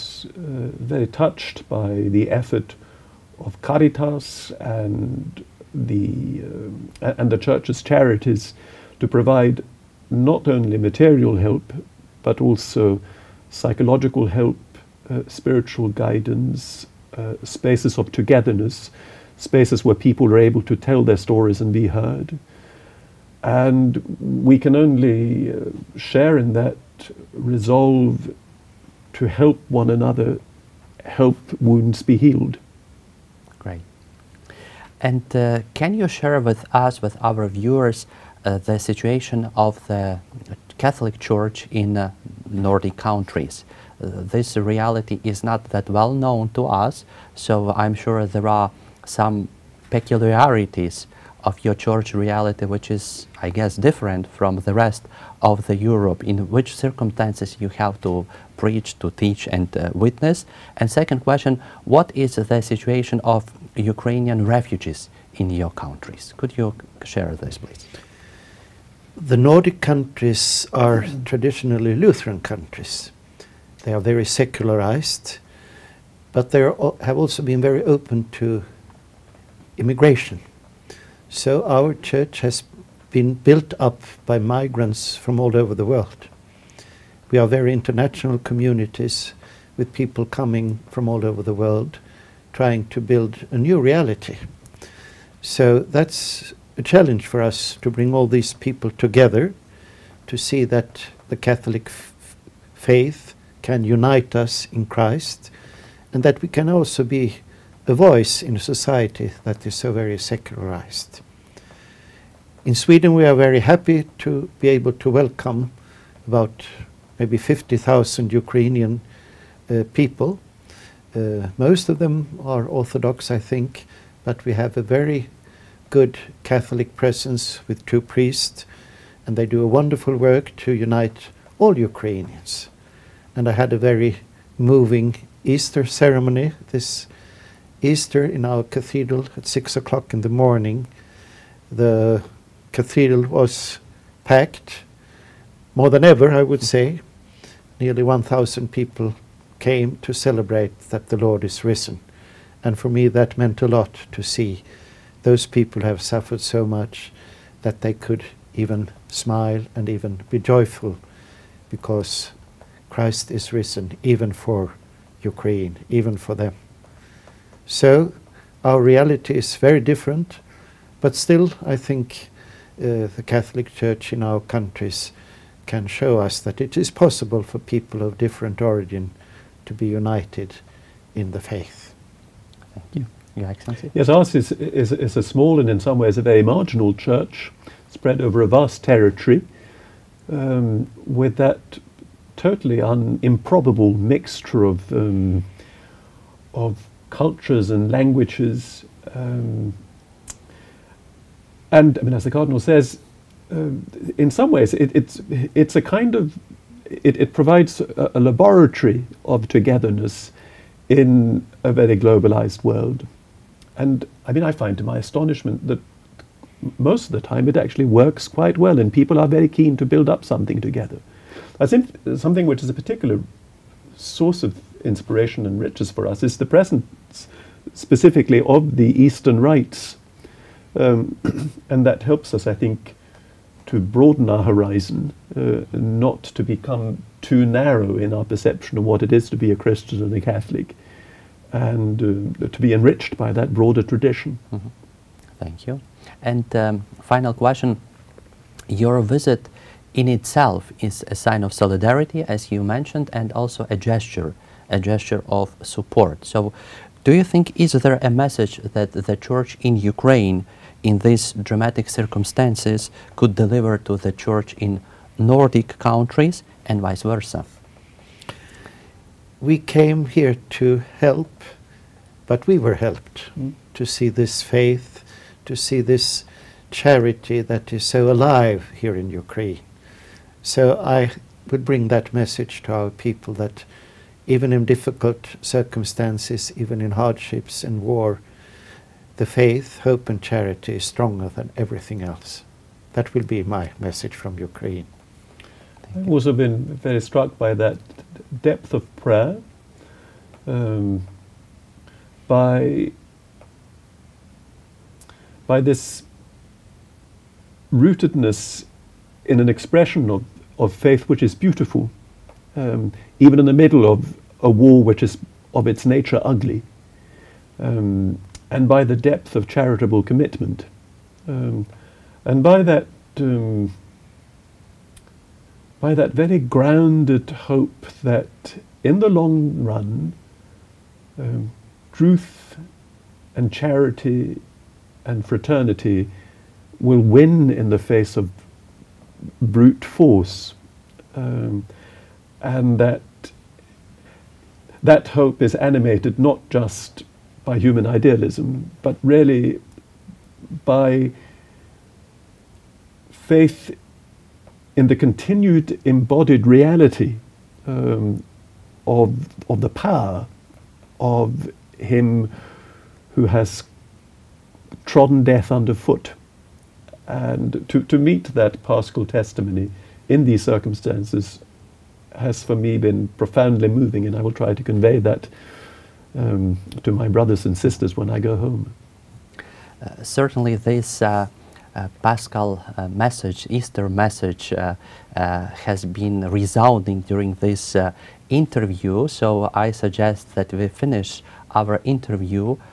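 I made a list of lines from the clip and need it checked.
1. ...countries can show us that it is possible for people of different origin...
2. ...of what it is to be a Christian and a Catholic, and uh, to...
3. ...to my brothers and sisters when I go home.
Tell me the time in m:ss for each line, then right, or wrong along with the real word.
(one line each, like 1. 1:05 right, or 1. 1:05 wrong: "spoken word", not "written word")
1. 2:54 right
2. 3:58 right
3. 6:16 right.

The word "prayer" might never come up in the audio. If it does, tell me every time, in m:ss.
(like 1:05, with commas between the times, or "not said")
4:58.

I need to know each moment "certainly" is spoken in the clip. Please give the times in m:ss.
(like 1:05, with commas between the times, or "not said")
6:20.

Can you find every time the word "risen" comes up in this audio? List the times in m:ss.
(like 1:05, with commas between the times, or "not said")
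2:31, 2:43.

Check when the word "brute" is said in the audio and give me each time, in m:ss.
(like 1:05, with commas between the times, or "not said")
5:39.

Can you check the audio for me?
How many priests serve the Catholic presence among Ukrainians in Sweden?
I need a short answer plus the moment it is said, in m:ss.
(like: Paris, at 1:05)
2, at 2:07.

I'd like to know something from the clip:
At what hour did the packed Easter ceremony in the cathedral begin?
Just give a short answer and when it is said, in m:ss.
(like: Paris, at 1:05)
6 o'clock, at 2:19.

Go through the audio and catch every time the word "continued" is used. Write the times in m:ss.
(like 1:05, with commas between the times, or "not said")
5:54.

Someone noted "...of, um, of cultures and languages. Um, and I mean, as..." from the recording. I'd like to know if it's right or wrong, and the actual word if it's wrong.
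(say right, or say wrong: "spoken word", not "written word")
right.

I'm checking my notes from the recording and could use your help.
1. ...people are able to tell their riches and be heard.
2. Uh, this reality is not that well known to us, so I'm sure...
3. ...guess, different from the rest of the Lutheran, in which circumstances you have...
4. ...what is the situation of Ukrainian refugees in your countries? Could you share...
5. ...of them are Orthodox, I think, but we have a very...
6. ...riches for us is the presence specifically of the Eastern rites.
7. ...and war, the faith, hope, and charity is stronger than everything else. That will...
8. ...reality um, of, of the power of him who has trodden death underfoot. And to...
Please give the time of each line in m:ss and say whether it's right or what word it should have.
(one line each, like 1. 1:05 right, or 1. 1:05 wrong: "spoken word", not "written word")
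1. 0:19 wrong: "stories", not "riches"
2. 0:44 right
3. 0:53 wrong: "Europe", not "Lutheran"
4. 1:01 right
5. 2:01 right
6. 3:45 right
7. 4:47 right
8. 5:56 right.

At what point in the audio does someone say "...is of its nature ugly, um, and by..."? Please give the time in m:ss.
5:15.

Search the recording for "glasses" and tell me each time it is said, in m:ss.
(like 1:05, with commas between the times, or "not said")
not said.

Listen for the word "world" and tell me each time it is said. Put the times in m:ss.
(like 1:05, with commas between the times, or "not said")
1:25, 1:31, 3:32.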